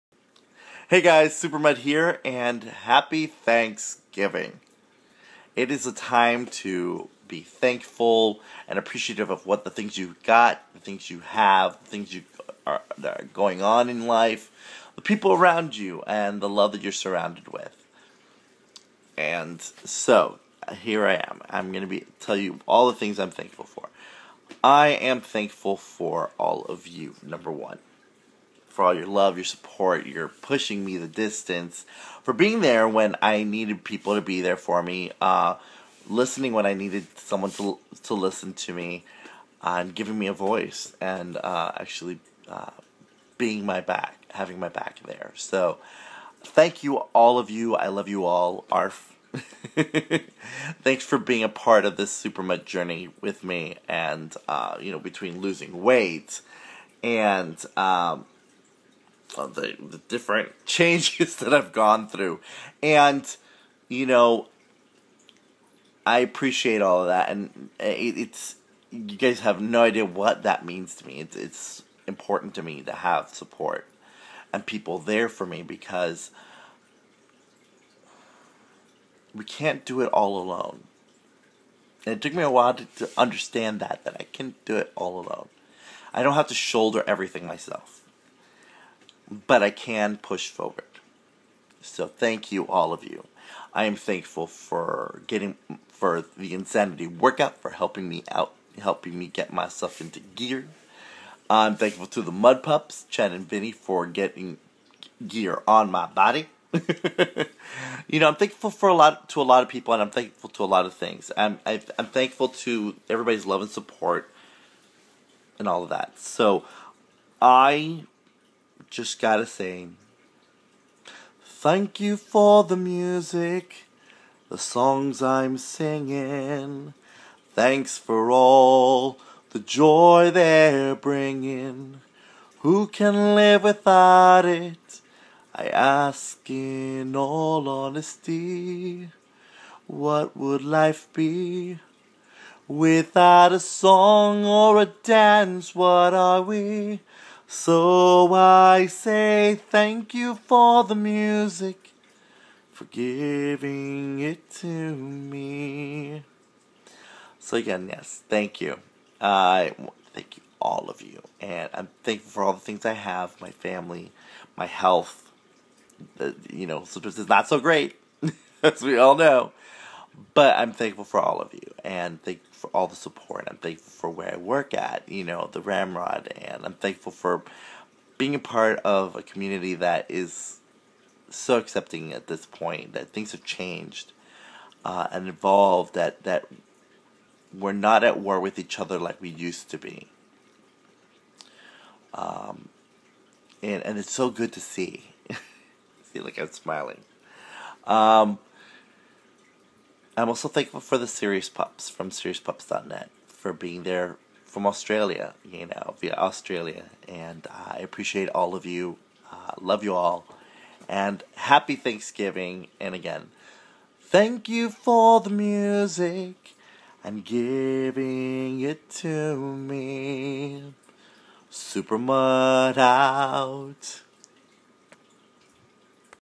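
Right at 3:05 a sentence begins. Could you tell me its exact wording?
That that we're not at war with each other like we used to be.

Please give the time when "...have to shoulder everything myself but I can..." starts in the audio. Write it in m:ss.
1:26.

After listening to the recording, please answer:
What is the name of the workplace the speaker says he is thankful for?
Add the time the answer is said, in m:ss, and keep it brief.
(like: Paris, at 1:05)
The Ramrod, at 2:55.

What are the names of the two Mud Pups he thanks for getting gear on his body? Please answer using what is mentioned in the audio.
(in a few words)
Chad and Vinny.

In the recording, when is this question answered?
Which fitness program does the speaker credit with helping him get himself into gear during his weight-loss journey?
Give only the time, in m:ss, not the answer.
1:36.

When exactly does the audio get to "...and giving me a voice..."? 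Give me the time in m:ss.
0:39.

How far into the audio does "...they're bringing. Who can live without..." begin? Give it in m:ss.
2:10.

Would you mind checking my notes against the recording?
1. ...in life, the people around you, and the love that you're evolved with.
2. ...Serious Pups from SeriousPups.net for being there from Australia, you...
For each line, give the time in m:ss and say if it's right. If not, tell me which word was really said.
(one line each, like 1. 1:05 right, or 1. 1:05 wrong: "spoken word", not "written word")
1. 0:13 wrong: "surrounded", not "evolved"
2. 3:21 right.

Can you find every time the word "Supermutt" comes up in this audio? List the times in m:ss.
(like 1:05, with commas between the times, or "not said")
0:01, 0:52, 3:41.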